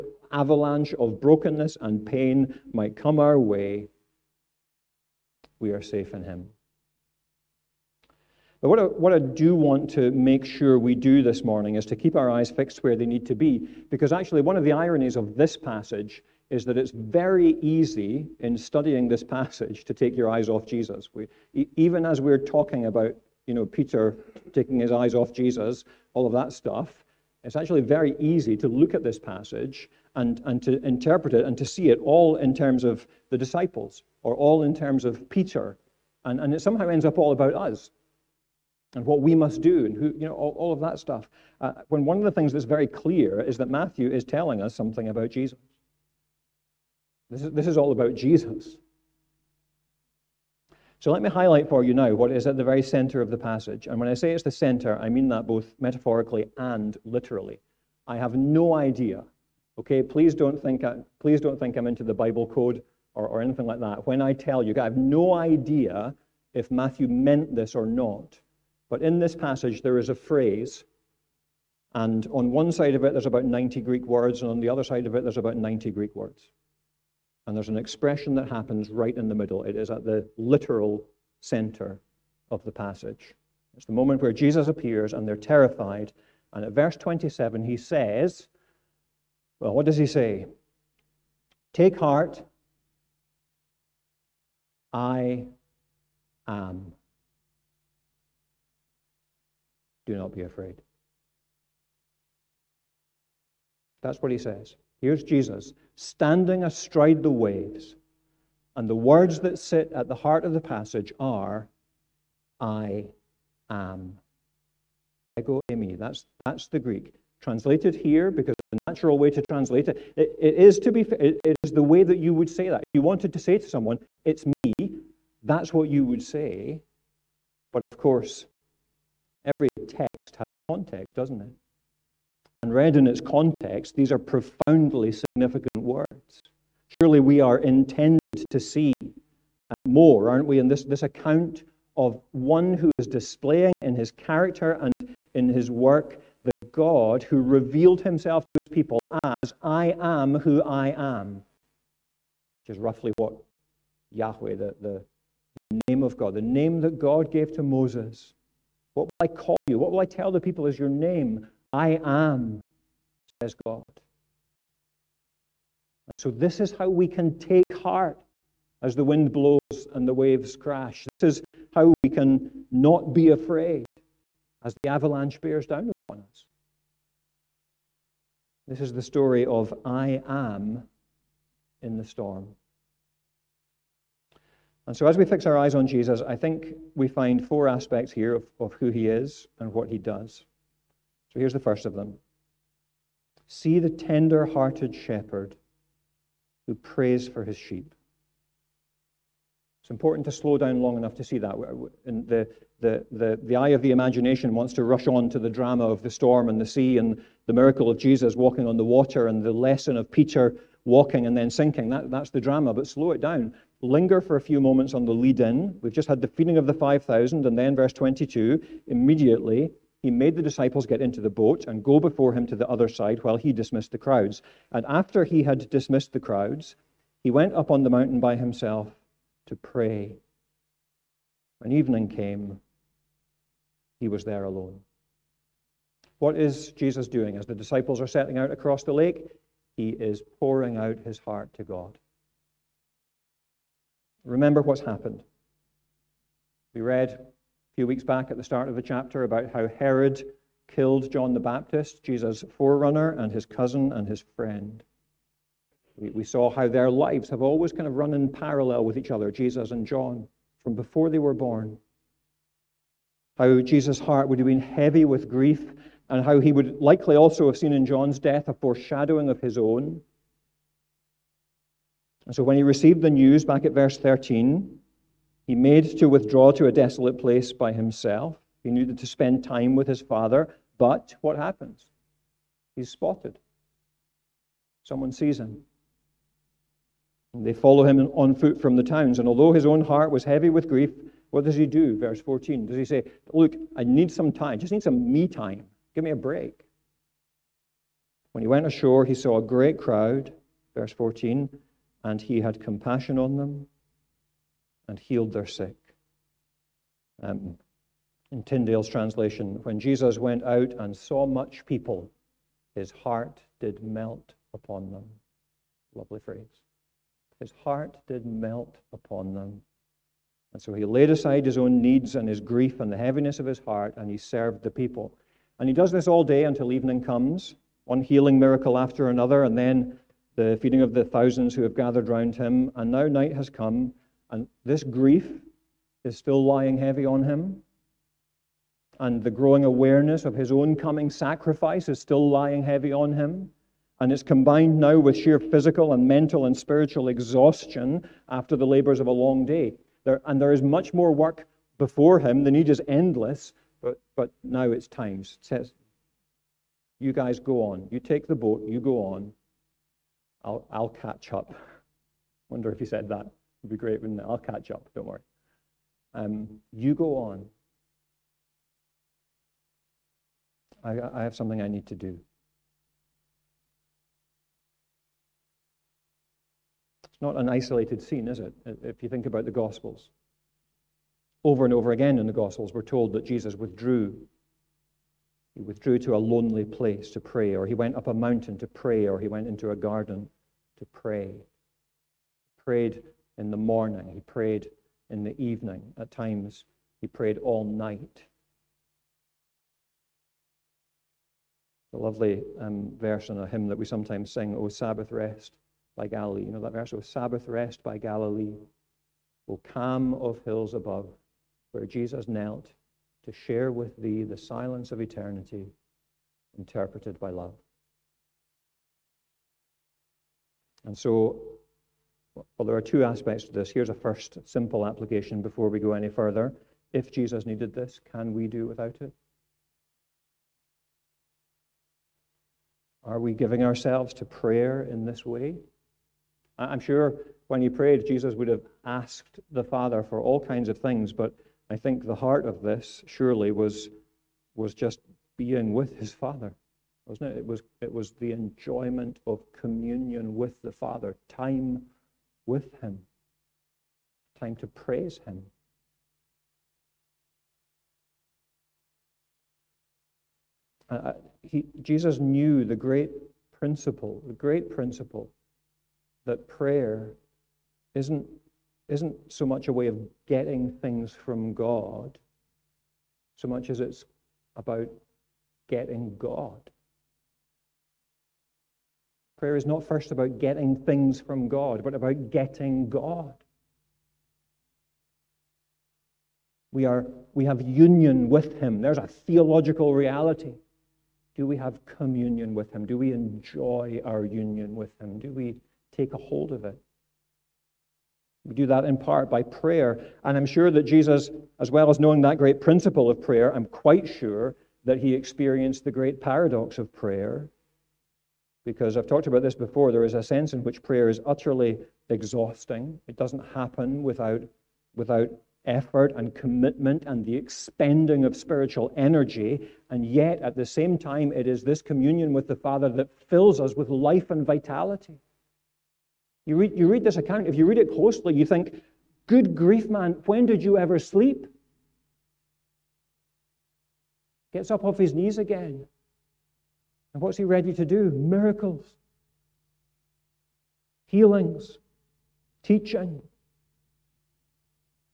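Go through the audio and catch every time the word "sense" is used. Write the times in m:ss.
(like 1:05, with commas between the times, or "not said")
8:30.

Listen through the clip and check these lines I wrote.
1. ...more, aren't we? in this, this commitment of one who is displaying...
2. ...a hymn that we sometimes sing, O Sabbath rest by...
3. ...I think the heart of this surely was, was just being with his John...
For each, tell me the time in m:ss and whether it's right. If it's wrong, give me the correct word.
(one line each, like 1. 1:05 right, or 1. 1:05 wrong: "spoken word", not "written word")
1. 2:19 wrong: "account", not "commitment"
2. 6:43 right
3. 7:21 wrong: "Father", not "John".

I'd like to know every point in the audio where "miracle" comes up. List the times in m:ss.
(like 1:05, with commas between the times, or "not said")
3:27, 5:28, 8:58.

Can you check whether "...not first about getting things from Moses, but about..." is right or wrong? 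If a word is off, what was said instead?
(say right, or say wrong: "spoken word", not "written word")
wrong: "God", not "Moses".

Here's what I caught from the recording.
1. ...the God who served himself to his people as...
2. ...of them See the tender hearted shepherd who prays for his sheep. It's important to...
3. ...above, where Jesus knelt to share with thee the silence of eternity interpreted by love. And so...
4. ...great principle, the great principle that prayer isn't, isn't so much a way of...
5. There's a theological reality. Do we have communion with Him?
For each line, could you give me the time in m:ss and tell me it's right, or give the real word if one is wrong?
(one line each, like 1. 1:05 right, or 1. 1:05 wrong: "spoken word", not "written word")
1. 2:26 wrong: "revealed", not "served"
2. 3:11 right
3. 6:50 right
4. 7:42 right
5. 8:08 right.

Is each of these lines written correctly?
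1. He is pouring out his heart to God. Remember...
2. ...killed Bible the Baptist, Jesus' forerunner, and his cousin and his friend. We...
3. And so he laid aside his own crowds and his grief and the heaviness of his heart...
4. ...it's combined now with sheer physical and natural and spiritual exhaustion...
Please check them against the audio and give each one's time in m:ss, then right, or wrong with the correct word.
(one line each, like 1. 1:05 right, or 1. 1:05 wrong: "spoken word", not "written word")
1. 3:59 right
2. 4:10 wrong: "John", not "Bible"
3. 5:20 wrong: "needs", not "crowds"
4. 5:44 wrong: "mental", not "natural".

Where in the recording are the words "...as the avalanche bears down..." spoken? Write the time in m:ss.
2:54.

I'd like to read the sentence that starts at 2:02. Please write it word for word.
If you wanted to say to someone, it's me, that's what you would say.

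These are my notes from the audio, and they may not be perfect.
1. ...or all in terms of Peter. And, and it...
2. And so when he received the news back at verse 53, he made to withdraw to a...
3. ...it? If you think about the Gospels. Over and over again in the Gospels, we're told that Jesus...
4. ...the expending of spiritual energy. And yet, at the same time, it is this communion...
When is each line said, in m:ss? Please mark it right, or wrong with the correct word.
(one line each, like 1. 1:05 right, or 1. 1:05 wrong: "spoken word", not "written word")
1. 0:34 right
2. 4:32 wrong: "13", not "53"
3. 6:18 right
4. 8:37 right.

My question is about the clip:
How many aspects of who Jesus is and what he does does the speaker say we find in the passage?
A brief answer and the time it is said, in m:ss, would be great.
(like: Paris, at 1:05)
4, at 3:07.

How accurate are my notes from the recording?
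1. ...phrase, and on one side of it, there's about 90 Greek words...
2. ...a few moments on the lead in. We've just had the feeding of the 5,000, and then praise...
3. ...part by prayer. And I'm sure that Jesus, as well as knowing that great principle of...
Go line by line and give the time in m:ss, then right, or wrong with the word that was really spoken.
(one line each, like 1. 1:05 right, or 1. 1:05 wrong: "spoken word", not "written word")
1. 1:10 right
2. 3:34 wrong: "verse", not "praise"
3. 8:18 right.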